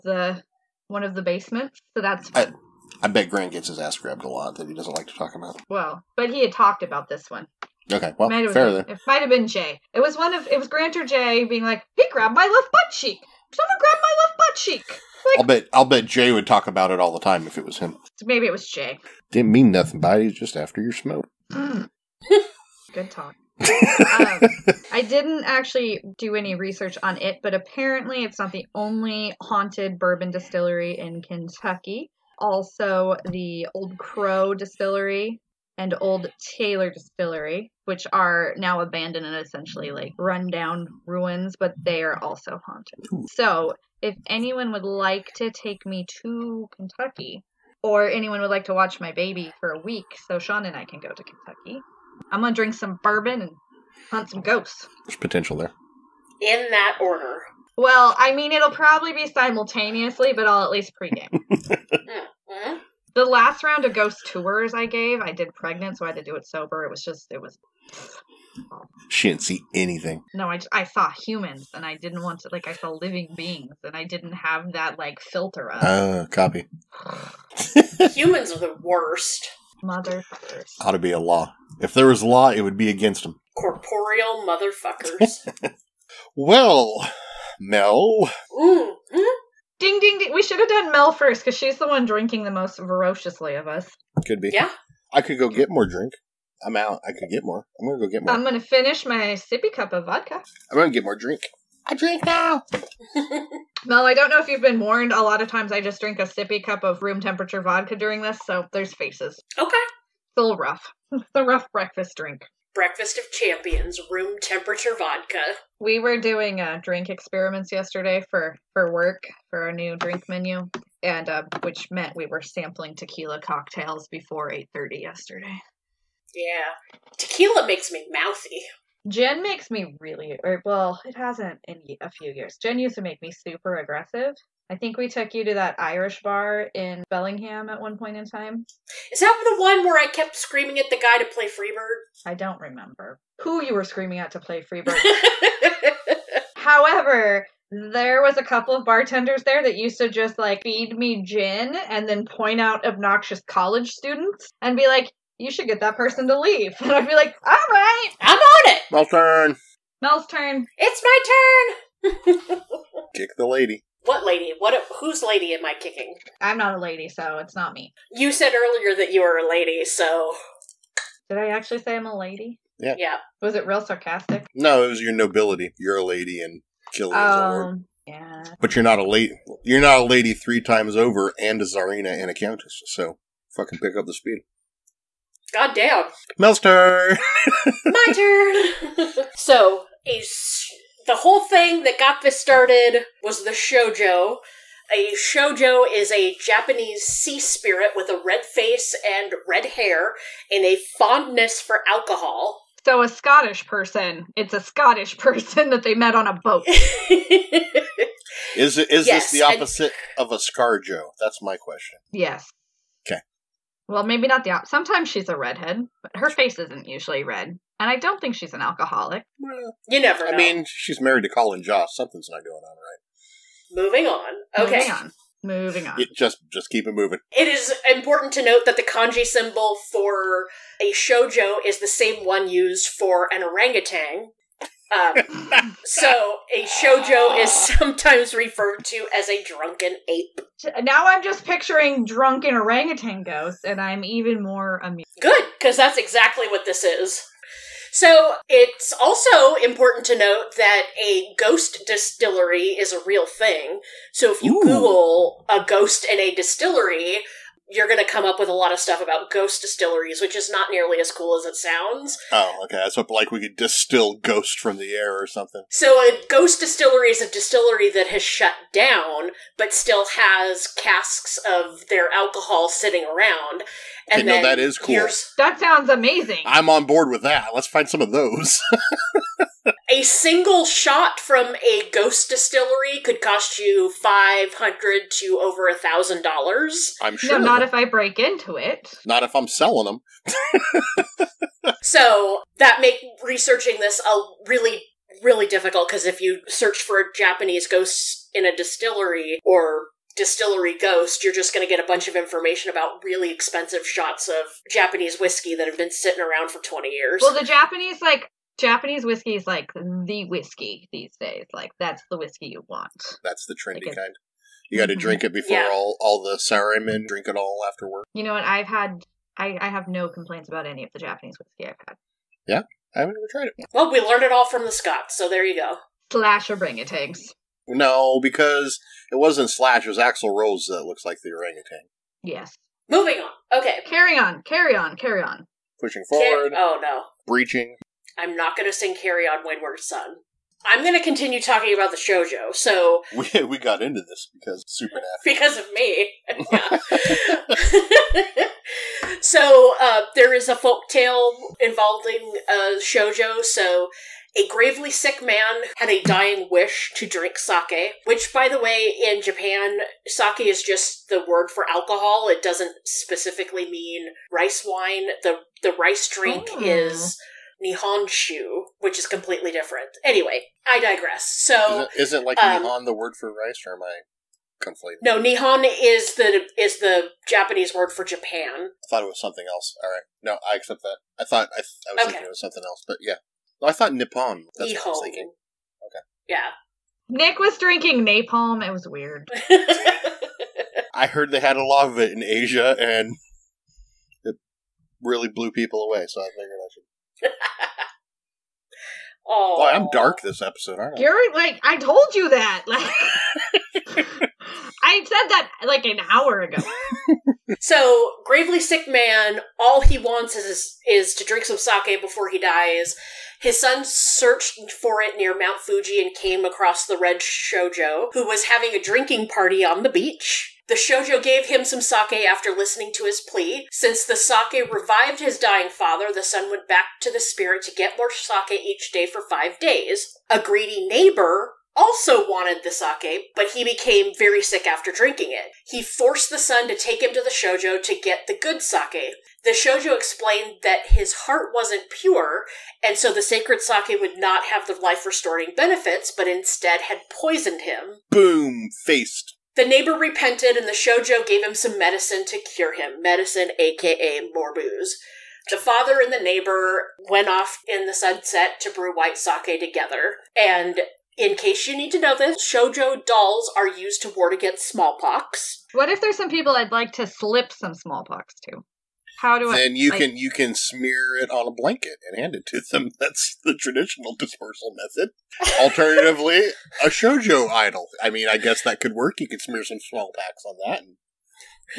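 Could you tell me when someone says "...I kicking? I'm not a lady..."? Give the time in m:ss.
2:45.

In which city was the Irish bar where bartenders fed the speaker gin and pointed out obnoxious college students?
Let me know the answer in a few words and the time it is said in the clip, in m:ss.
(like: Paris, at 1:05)
Bellingham, at 2:17.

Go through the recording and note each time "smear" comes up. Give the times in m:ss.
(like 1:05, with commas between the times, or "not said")
7:50, 7:59.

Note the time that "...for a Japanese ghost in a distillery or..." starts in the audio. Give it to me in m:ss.
4:56.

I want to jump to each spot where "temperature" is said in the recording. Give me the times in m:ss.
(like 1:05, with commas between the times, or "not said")
1:47, 1:54.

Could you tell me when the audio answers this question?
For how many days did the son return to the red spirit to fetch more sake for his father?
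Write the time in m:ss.
7:09.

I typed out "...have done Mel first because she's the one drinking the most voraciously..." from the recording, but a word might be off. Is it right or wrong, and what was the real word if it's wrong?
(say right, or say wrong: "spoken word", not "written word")
right.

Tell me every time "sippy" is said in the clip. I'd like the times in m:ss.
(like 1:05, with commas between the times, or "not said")
1:39, 1:46.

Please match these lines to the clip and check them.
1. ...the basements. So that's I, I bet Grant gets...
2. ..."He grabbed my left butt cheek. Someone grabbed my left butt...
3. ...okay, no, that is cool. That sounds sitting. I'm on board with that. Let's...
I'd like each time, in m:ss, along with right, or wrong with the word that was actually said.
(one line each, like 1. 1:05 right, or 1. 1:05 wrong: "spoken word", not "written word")
1. 0:01 right
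2. 0:11 right
3. 4:34 wrong: "amazing", not "sitting".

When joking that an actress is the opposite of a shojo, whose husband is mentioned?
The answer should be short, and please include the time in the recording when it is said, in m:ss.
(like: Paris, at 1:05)
Colin Jost, at 3:41.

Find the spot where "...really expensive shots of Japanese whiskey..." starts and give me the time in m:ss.
5:03.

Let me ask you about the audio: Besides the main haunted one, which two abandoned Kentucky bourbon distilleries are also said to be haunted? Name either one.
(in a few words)
Old Crow Distillery.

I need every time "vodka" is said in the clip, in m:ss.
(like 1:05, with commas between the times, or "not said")
1:40, 1:47, 1:54.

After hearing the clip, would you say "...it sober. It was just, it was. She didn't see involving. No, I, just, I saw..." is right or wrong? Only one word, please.
wrong.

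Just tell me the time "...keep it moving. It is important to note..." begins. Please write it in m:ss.
3:46.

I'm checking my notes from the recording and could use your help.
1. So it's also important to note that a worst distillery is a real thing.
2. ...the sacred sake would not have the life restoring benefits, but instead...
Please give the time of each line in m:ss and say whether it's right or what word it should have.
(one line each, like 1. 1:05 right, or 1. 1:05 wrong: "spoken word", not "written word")
1. 4:07 wrong: "ghost", not "worst"
2. 7:23 right.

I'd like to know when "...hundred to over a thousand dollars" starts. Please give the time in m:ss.
4:44.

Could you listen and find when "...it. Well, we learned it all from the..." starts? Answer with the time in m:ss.
5:23.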